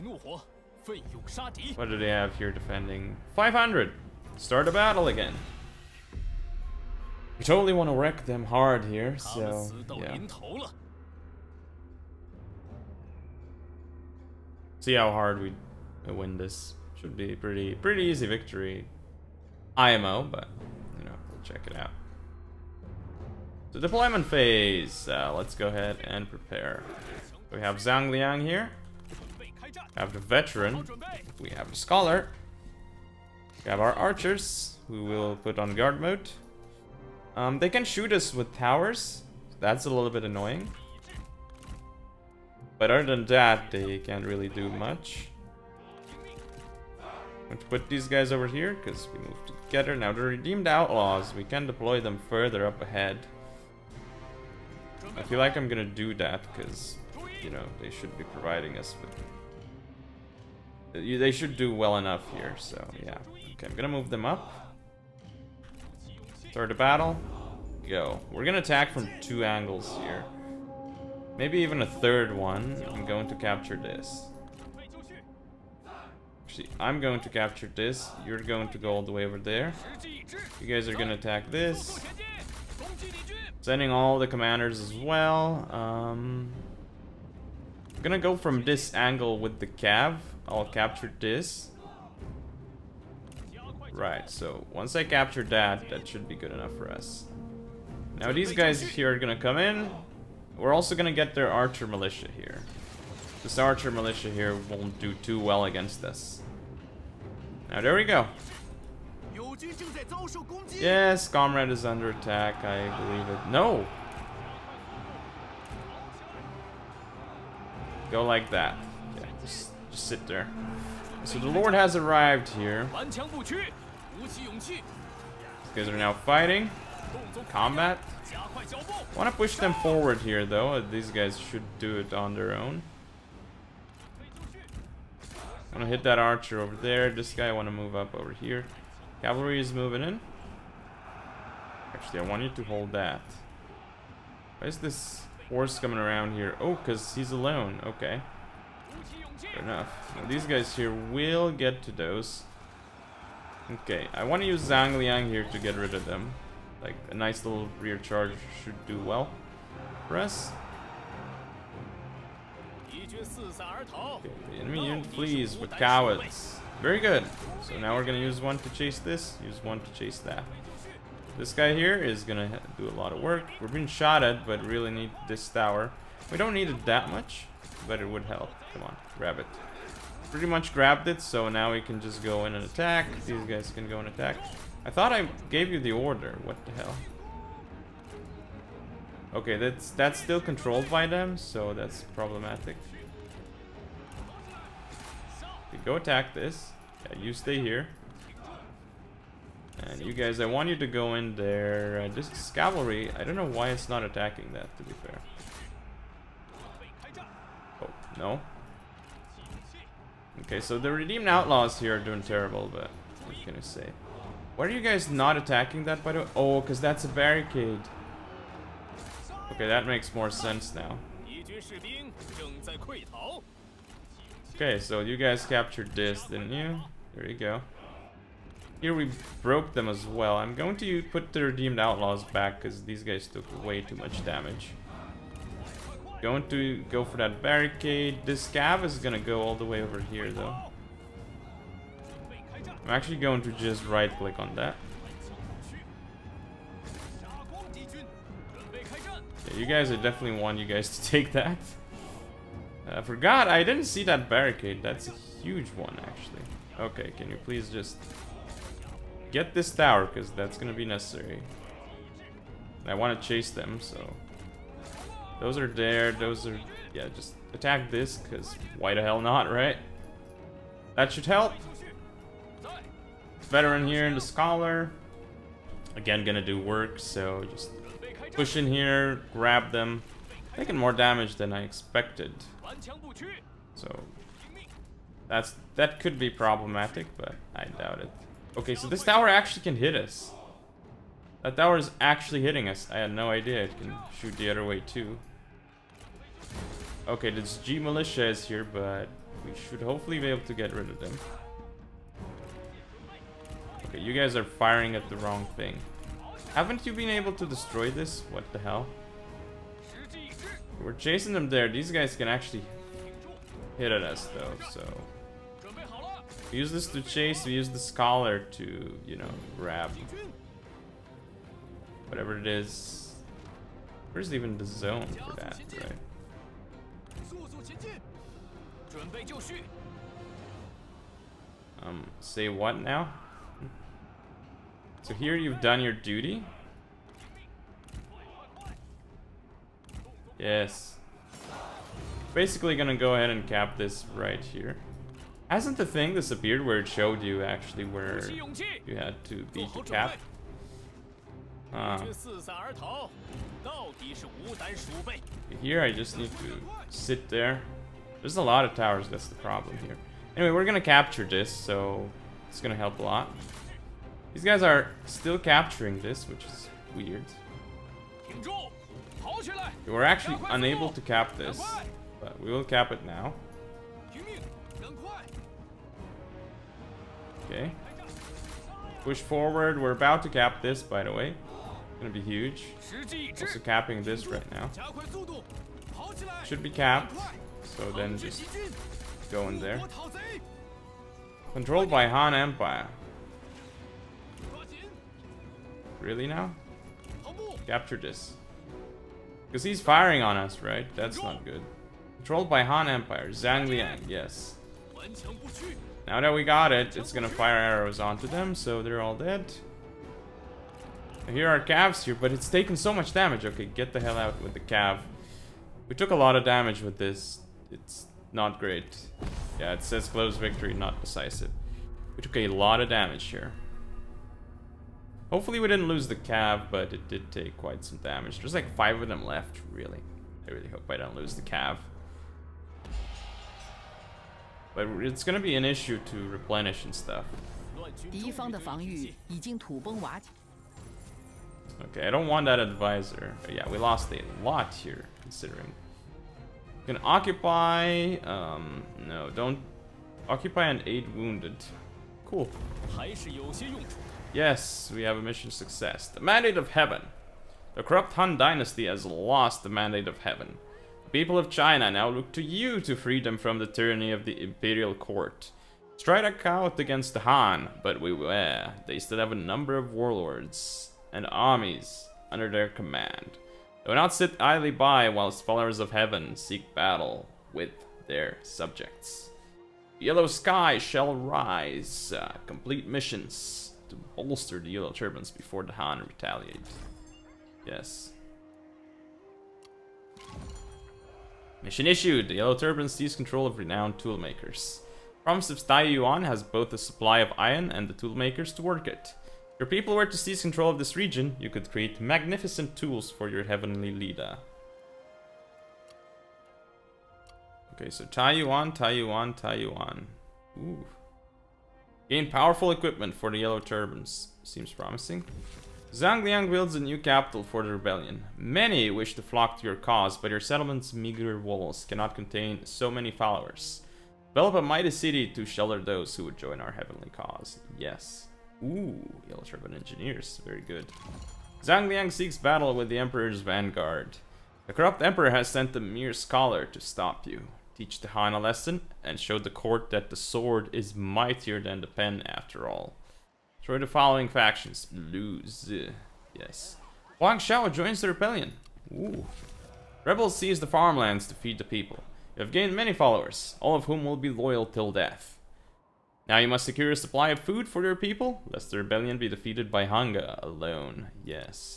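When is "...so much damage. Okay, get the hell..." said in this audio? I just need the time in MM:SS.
06:52.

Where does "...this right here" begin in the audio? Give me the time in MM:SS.
05:43.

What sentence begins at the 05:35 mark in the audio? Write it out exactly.
So here you've done your duty.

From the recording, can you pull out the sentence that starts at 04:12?
I forgot, I didn't see that barricade.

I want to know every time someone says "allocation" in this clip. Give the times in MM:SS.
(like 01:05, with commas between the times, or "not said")
not said.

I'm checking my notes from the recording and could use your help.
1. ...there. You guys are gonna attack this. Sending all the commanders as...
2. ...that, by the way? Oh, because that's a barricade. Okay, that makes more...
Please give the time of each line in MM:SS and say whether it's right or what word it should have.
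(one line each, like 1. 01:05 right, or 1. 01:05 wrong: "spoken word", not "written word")
1. 01:19 right
2. 03:35 right.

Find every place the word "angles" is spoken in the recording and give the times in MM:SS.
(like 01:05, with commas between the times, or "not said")
01:09, 01:28.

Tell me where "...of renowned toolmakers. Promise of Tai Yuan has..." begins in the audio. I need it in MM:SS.
08:13.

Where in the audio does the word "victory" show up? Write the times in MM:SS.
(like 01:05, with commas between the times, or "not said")
00:18, 07:00.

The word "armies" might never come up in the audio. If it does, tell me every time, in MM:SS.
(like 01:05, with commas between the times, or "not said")
07:51.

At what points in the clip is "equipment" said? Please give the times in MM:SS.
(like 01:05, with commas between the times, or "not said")
08:32.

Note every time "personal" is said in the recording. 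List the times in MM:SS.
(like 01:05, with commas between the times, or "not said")
not said.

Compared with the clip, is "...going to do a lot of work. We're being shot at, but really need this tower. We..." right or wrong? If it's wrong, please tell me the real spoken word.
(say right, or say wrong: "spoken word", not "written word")
right.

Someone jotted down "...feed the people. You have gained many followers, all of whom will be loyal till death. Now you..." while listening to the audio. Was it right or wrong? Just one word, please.
right.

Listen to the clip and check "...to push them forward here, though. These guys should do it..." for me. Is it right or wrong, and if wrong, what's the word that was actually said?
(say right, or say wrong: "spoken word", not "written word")
right.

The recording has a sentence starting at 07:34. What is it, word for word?
Yes, we have a mission success.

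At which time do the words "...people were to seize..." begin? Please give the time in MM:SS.
08:19.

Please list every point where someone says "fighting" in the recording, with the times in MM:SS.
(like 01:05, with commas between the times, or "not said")
02:06.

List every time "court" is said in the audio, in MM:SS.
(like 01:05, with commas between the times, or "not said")
07:44, 08:59.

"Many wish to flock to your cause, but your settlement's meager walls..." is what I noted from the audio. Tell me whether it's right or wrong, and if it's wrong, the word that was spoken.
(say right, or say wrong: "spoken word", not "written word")
right.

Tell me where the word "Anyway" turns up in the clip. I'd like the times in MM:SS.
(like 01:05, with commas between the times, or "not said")
06:00.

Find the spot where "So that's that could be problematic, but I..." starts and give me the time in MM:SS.
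04:43.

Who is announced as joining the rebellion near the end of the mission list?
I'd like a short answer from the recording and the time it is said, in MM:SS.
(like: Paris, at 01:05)
Wang Xiao, at 09:07.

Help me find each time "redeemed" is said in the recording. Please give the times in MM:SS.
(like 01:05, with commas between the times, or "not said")
00:50, 03:30, 03:51.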